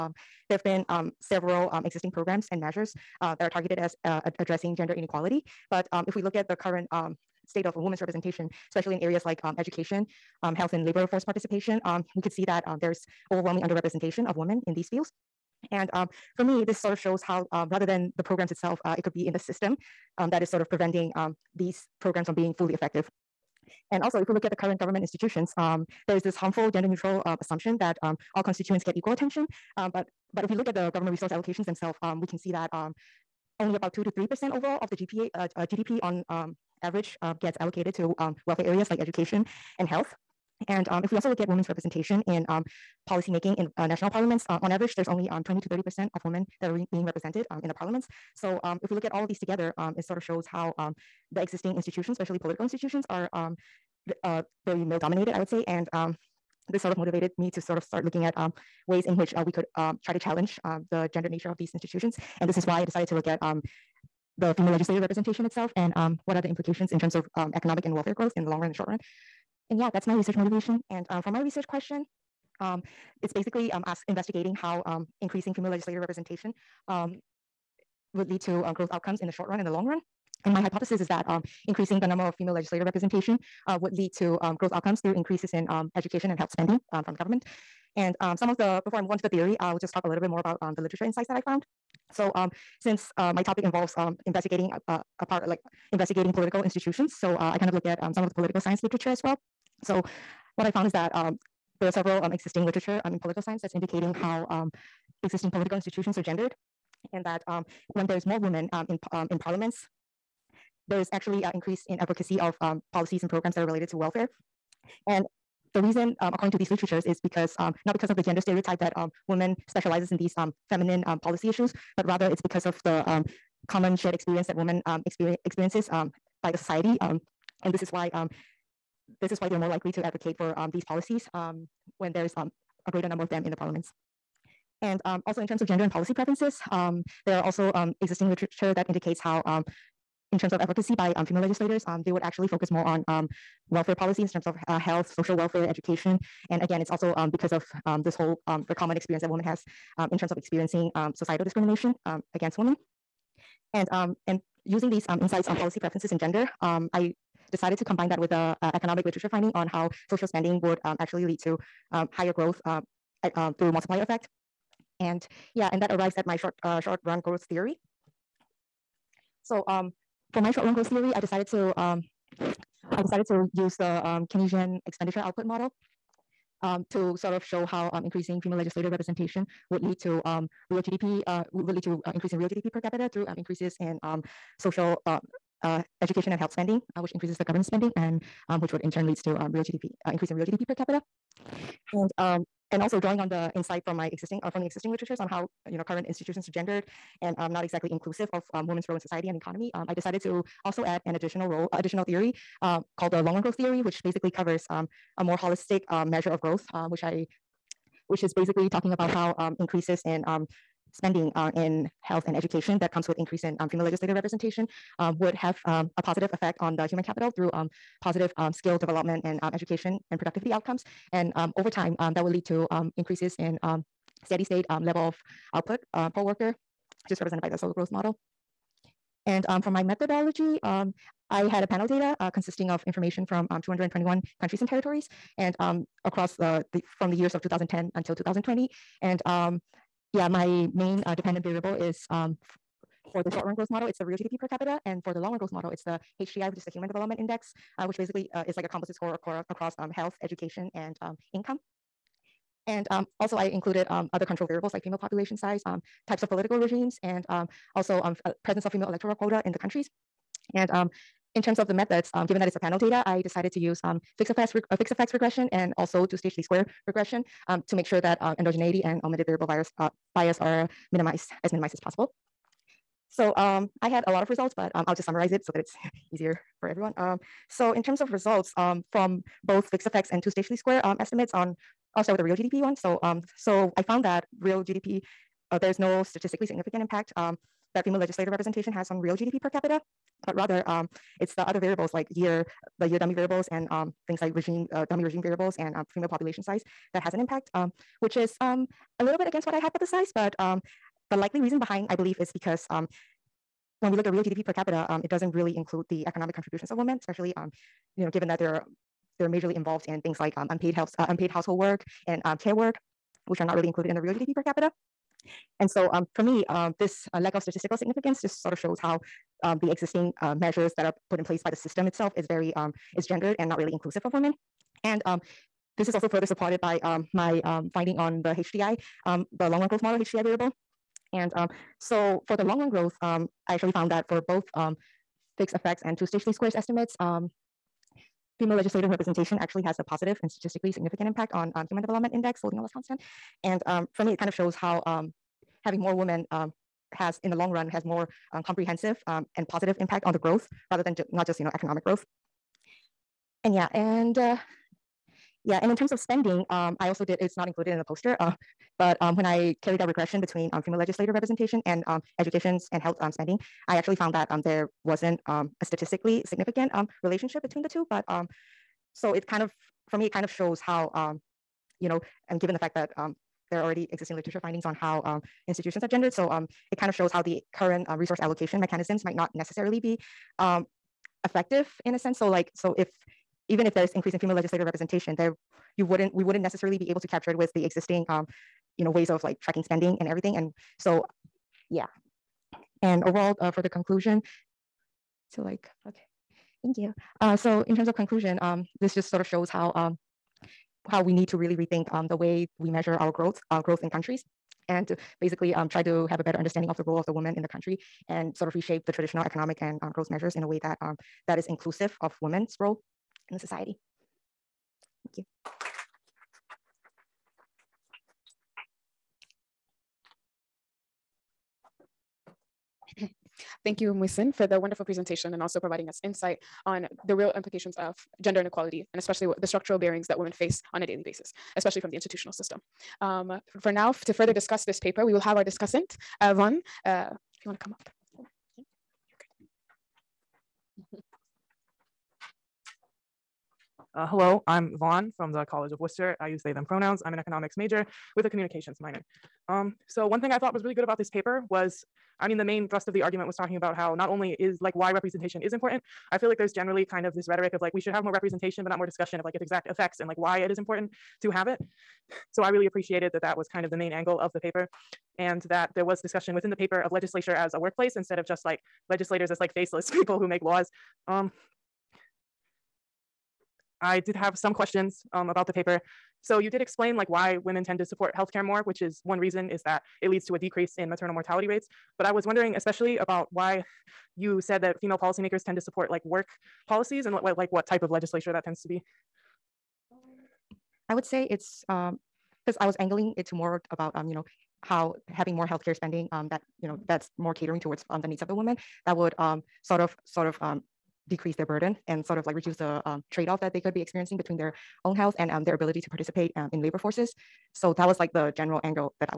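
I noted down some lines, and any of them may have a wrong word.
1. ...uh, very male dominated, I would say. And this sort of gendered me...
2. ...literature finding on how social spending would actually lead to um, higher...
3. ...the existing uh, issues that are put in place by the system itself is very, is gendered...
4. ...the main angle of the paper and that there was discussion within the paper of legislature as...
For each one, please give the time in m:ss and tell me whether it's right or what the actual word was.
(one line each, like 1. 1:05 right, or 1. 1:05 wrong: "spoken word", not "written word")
1. 0:53 wrong: "motivated", not "gendered"
2. 2:39 right
3. 5:19 wrong: "measures", not "issues"
4. 7:43 right.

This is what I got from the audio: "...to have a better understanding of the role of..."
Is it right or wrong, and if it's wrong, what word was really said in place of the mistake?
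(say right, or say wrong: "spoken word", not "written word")
right.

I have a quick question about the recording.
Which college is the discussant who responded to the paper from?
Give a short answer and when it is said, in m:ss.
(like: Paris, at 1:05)
College of Wooster, at 7:25.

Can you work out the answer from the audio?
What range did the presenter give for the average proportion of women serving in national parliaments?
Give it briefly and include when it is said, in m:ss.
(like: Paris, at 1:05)
20 to 30%, at 0:45.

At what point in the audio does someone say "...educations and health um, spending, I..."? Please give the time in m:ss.
6:02.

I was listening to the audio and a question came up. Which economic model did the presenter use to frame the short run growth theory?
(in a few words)
Keynesian expenditure output model.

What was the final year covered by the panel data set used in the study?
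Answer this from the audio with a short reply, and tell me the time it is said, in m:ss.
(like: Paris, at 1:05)
2020, at 3:58.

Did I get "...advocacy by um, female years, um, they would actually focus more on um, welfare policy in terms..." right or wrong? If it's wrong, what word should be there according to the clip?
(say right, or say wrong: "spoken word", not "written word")
wrong: "legislators", not "years".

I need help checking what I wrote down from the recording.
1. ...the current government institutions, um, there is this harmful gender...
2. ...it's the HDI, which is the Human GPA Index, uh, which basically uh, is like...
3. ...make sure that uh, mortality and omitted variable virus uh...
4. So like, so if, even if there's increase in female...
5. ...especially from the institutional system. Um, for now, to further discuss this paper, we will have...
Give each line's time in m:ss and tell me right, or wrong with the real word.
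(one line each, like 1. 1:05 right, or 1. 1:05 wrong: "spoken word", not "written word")
1. 0:24 right
2. 4:05 wrong: "Development", not "GPA"
3. 4:27 wrong: "endogeneity", not "mortality"
4. 6:22 right
5. 7:11 right.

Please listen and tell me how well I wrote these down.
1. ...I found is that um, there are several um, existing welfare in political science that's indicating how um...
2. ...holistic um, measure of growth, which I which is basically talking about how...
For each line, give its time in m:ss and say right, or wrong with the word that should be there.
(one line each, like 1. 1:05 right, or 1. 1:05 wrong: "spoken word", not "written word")
1. 1:40 wrong: "literature", not "welfare"
2. 3:25 right.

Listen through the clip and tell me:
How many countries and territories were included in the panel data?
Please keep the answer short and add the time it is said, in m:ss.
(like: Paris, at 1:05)
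221, at 3:53.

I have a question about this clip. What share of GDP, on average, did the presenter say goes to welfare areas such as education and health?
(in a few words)
2 to 3 percent.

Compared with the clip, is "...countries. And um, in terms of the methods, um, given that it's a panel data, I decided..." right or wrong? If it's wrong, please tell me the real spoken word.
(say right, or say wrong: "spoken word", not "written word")
right.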